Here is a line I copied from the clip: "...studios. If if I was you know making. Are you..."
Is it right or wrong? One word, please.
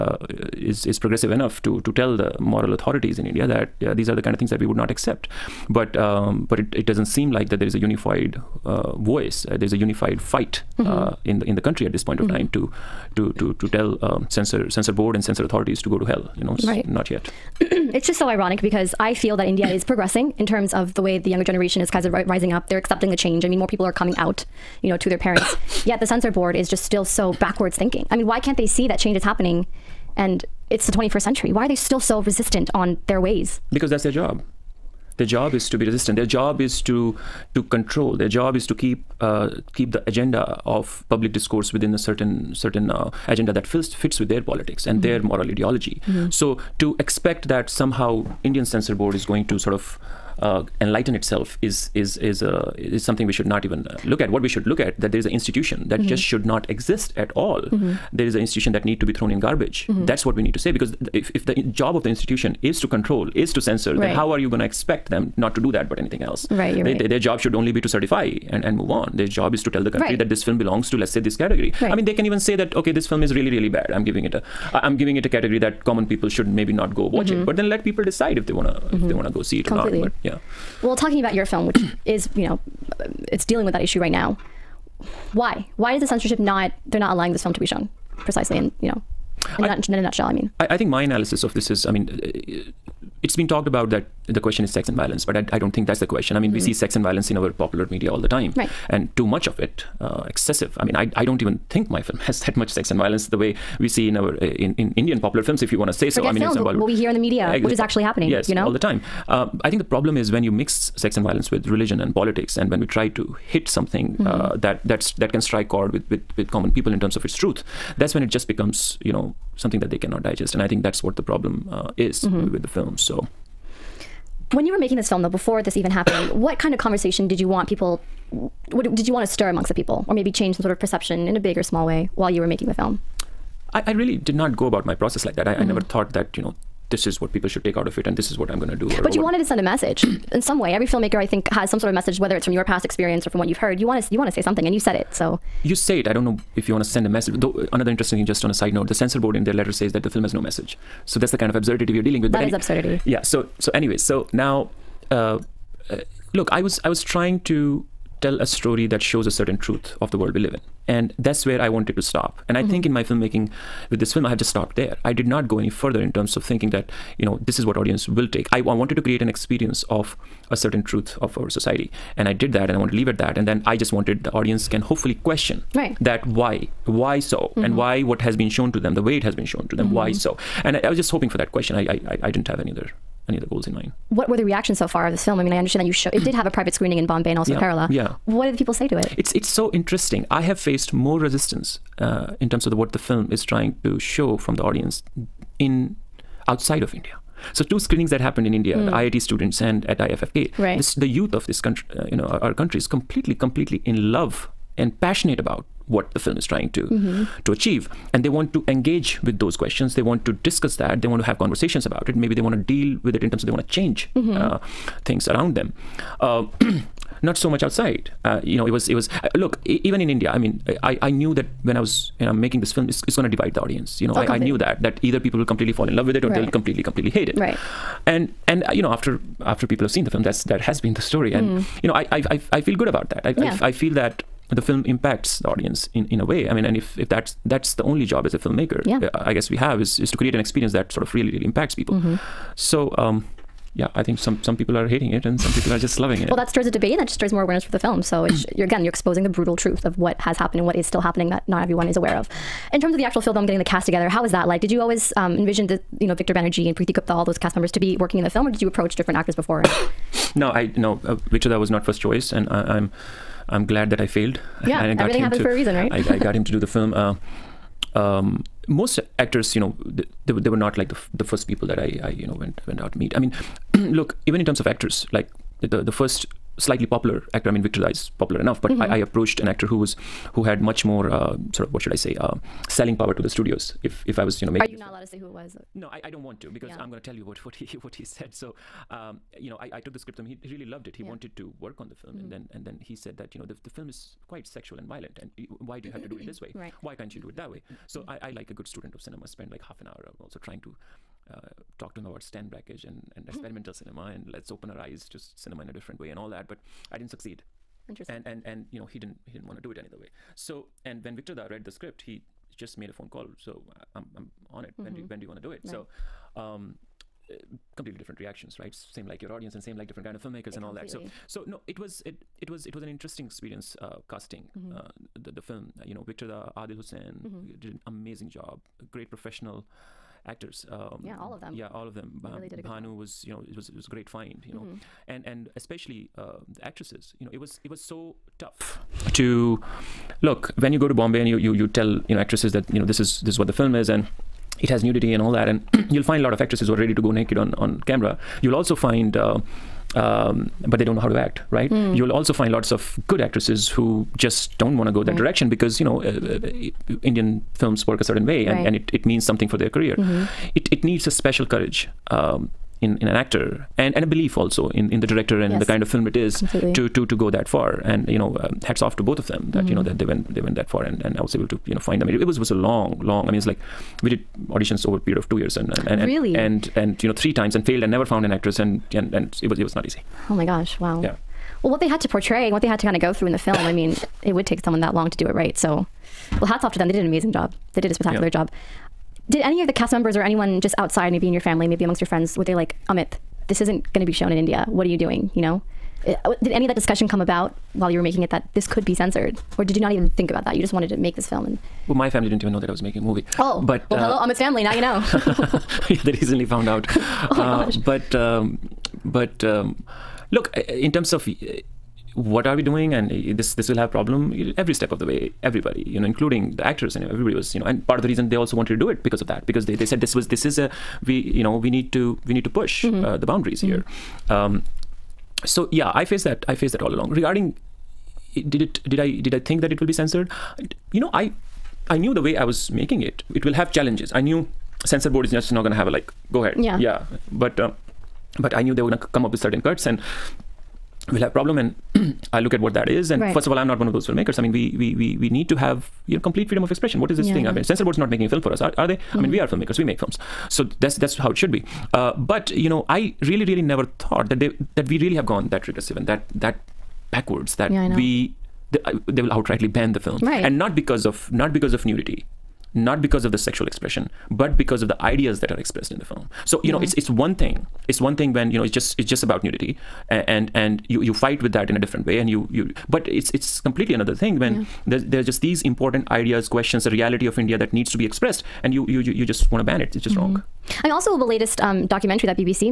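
right.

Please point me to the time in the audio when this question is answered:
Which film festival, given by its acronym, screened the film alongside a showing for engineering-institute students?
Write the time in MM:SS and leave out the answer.
03:19.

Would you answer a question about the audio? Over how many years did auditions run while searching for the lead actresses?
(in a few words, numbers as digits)
2.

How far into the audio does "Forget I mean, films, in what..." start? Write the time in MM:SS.
01:46.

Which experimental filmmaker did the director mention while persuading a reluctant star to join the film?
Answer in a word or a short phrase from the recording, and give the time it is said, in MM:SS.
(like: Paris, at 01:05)
Stan Brakhage, at 05:02.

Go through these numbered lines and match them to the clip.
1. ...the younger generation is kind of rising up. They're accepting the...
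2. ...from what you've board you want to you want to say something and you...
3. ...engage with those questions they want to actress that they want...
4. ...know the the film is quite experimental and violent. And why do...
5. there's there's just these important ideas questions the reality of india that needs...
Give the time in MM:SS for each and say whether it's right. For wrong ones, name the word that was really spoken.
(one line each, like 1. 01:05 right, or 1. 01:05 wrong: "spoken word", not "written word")
1. 00:21 right
2. 02:23 wrong: "heard", not "board"
3. 03:28 wrong: "discuss", not "actress"
4. 04:53 wrong: "sexual", not "experimental"
5. 07:54 right.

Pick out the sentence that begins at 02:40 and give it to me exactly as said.
And that's where I wanted to stop.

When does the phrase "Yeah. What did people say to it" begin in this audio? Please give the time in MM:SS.
03:07.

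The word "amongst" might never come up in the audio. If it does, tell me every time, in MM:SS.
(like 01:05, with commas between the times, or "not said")
02:09, 06:31.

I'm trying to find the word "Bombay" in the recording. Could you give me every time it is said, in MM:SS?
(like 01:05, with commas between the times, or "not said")
03:07, 05:40.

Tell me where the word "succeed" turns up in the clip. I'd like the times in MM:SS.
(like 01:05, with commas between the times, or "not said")
05:07.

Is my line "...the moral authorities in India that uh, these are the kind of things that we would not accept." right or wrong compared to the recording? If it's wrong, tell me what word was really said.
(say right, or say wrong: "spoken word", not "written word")
right.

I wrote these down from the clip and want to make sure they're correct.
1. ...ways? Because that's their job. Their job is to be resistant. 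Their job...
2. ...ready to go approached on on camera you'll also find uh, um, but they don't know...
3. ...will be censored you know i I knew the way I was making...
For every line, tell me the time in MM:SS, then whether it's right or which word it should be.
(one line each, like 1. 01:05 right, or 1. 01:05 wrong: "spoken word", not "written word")
1. 00:33 right
2. 05:46 wrong: "naked", not "approached"
3. 07:09 right.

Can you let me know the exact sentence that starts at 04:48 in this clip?
So, um, you know, I, I took the script to him.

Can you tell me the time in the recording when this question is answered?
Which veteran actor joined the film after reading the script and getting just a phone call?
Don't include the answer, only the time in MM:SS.
04:16.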